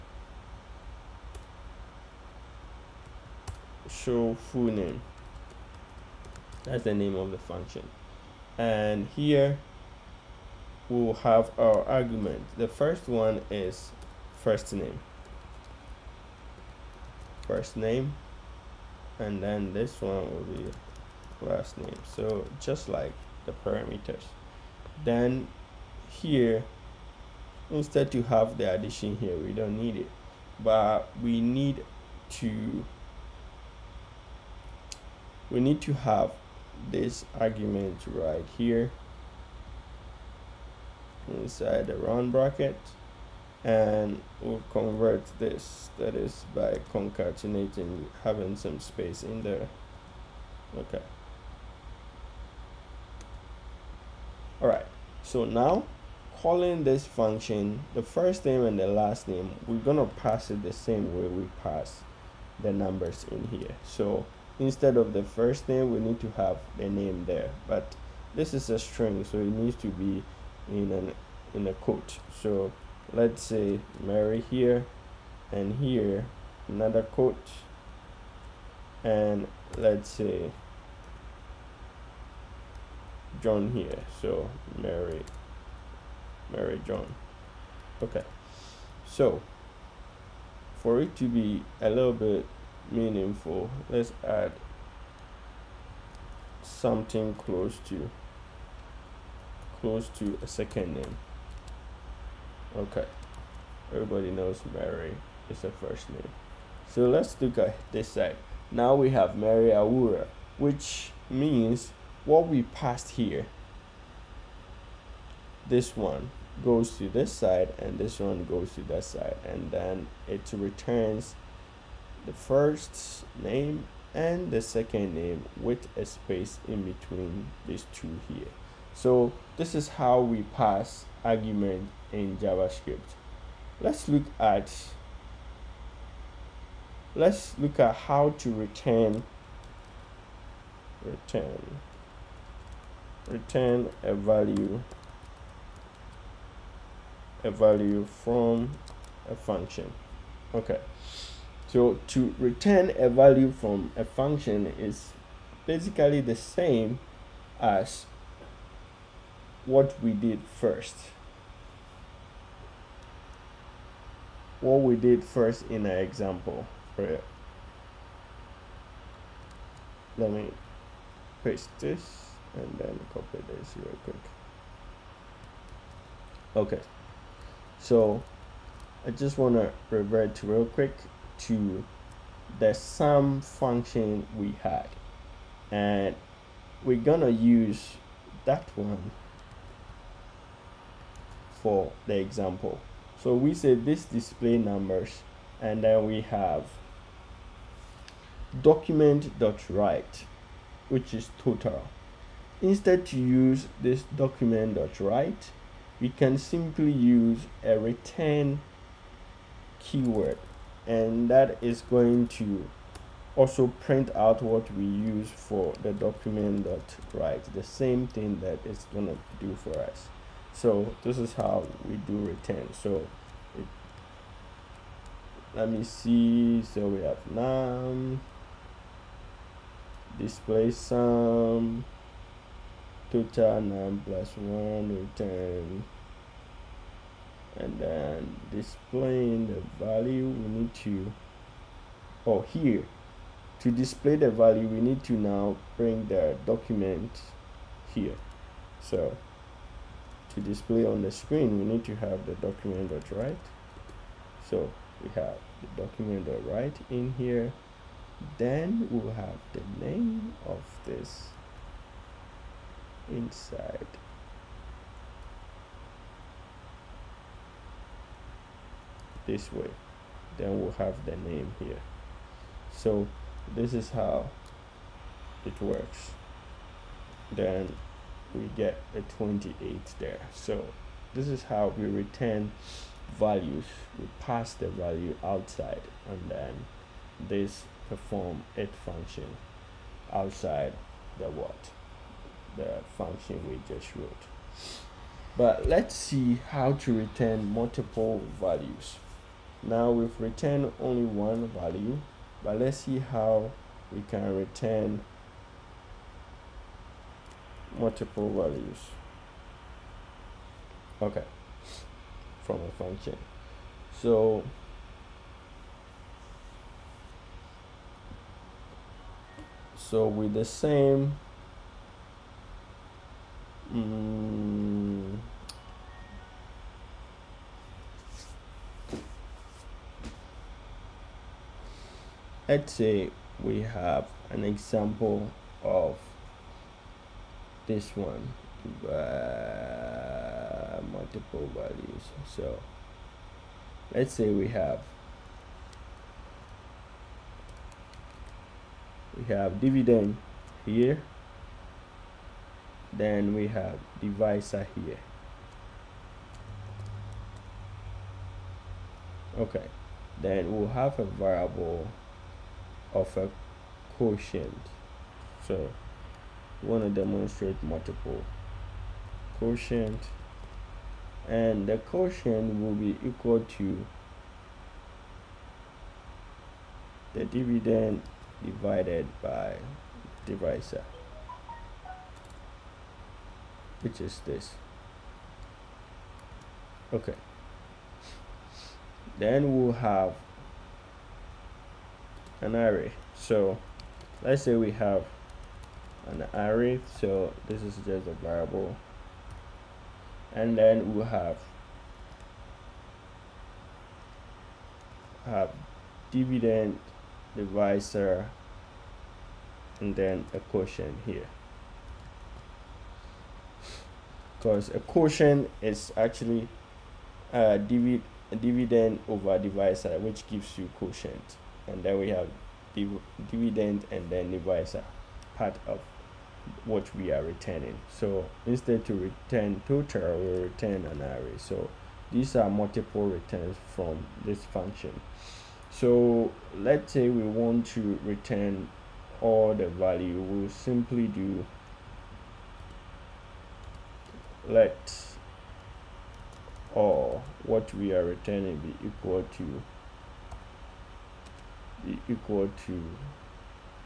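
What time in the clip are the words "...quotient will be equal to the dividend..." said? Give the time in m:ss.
6:11.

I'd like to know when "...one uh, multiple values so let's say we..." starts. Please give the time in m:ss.
5:37.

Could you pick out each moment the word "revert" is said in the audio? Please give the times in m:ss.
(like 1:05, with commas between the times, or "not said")
2:59.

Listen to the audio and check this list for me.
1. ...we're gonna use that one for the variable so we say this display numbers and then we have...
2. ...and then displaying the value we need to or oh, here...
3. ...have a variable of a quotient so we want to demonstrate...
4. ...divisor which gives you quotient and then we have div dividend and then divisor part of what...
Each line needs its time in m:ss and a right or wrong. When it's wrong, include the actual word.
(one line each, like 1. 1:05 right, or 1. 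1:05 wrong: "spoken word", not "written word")
1. 3:06 wrong: "example", not "variable"
2. 3:57 right
3. 6:00 right
4. 6:59 right.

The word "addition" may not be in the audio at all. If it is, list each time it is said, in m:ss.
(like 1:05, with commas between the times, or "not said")
0:28.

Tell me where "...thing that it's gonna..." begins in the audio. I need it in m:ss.
3:38.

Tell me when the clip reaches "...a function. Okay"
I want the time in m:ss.
2:29.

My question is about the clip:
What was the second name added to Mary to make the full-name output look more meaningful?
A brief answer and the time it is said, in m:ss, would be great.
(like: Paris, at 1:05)
Awura, at 1:49.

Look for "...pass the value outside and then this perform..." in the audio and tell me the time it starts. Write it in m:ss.
4:44.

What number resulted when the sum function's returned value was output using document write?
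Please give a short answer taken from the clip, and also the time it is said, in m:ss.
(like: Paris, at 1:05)
28, at 4:39.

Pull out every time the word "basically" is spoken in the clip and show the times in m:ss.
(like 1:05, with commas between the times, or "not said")
2:35.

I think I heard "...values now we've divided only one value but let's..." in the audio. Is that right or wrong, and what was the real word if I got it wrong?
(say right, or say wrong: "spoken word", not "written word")
wrong: "returned", not "divided".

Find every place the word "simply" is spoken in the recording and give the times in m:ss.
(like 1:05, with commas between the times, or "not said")
3:26, 7:20.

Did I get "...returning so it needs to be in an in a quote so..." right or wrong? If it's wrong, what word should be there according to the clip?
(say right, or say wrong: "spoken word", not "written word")
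wrong: "string", not "returning".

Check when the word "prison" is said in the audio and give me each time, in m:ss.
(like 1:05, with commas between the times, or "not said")
not said.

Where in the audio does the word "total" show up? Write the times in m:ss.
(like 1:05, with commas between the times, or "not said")
3:21, 3:53, 7:09.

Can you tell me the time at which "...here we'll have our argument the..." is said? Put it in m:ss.
0:09.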